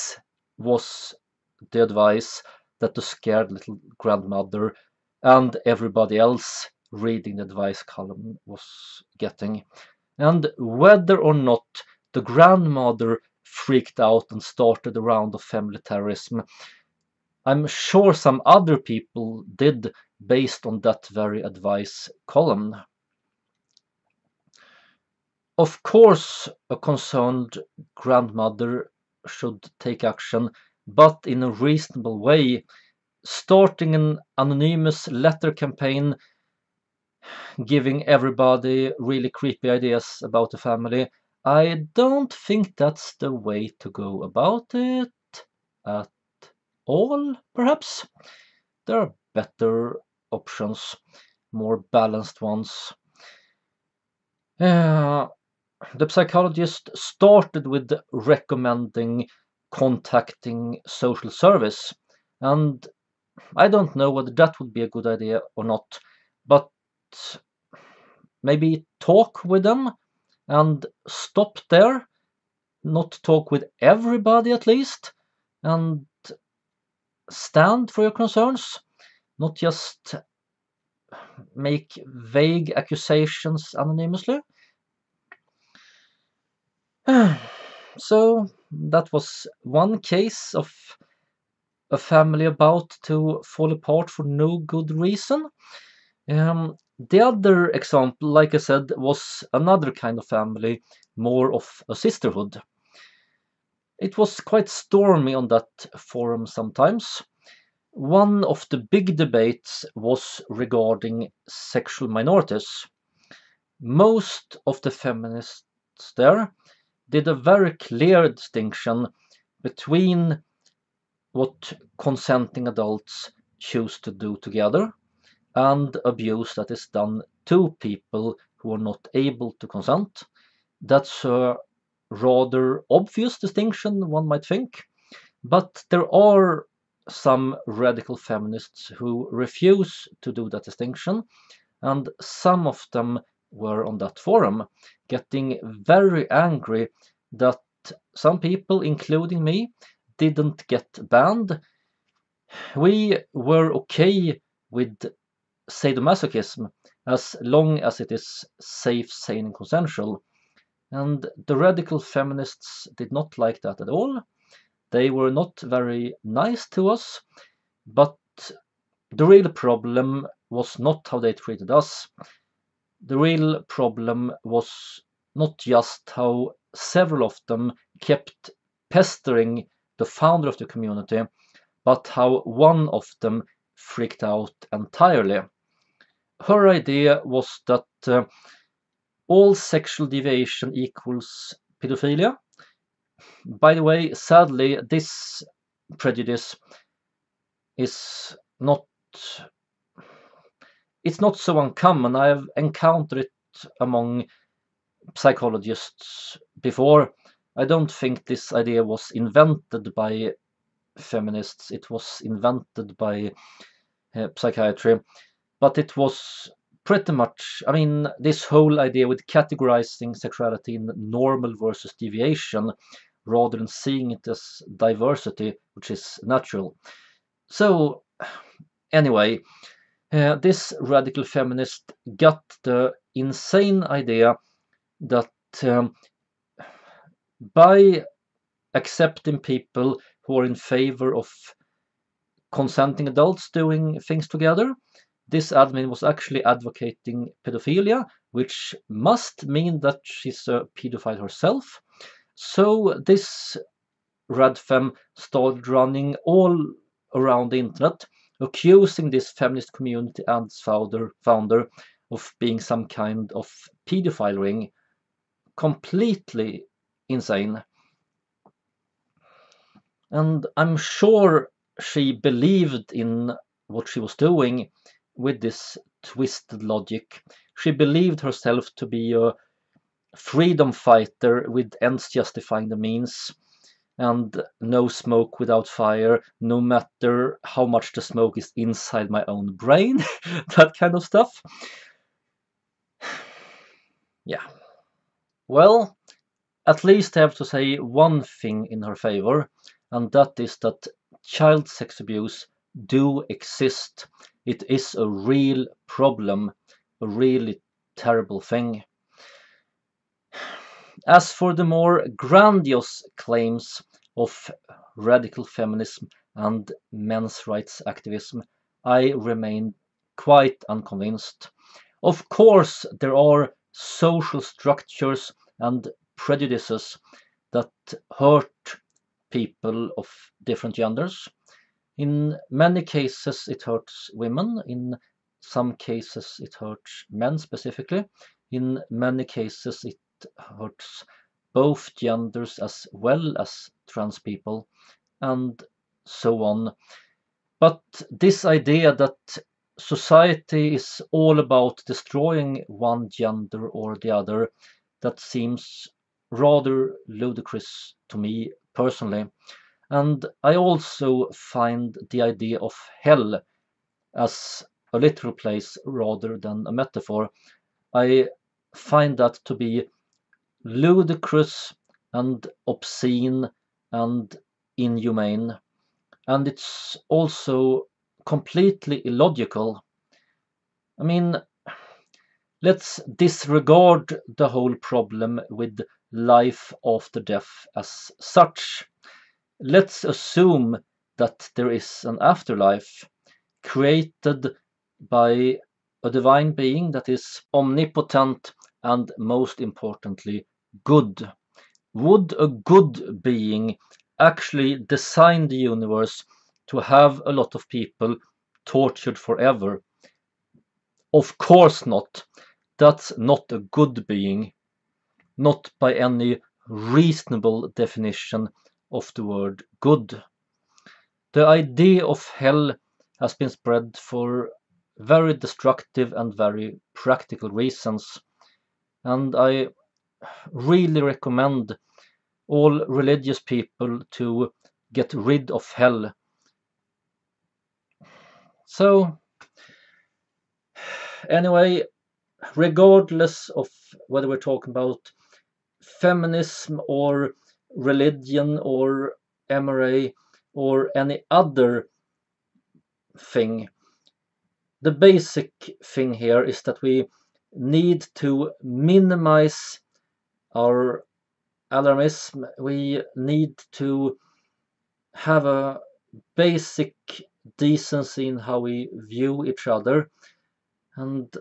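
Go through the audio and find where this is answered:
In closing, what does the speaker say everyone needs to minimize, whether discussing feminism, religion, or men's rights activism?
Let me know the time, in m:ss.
7:41.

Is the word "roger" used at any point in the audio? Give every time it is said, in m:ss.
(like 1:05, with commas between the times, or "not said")
not said.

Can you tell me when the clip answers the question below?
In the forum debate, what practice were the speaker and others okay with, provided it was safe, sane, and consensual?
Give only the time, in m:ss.
2:35.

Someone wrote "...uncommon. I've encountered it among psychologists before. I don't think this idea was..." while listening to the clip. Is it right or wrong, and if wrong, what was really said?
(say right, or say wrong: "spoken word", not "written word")
right.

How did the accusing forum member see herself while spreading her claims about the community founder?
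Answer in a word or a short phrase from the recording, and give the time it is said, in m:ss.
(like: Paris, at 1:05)
A freedom fighter, at 4:40.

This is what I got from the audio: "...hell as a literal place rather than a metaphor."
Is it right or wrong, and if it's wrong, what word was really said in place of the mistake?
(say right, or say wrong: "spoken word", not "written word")
right.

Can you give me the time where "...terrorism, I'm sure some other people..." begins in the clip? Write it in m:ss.
0:15.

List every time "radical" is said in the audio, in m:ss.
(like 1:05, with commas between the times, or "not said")
2:17, 2:41, 3:50, 5:14.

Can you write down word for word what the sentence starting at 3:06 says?
Her idea was that uh, all sexual deviation equals pedophilia.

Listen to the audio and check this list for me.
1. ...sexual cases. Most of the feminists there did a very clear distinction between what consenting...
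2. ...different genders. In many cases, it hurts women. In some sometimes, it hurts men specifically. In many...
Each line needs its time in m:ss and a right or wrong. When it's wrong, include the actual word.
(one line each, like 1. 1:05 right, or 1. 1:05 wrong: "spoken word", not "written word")
1. 1:51 wrong: "minorities", not "cases"
2. 5:30 wrong: "cases", not "sometimes".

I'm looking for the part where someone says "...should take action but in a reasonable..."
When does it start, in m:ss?
0:29.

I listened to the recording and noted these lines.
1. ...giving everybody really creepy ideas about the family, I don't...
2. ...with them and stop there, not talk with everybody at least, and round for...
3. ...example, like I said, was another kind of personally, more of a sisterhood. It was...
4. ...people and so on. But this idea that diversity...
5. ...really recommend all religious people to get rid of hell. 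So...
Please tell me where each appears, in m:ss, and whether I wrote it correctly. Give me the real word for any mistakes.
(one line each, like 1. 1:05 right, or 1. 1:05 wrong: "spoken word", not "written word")
1. 0:37 right
2. 1:09 wrong: "stand", not "round"
3. 1:37 wrong: "family", not "personally"
4. 5:44 wrong: "society", not "diversity"
5. 7:10 right.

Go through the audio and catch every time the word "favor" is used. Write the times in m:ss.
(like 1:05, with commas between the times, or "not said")
4:00, 4:58.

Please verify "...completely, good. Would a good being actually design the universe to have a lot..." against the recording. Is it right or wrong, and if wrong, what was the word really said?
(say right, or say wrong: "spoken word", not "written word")
wrong: "importantly", not "completely".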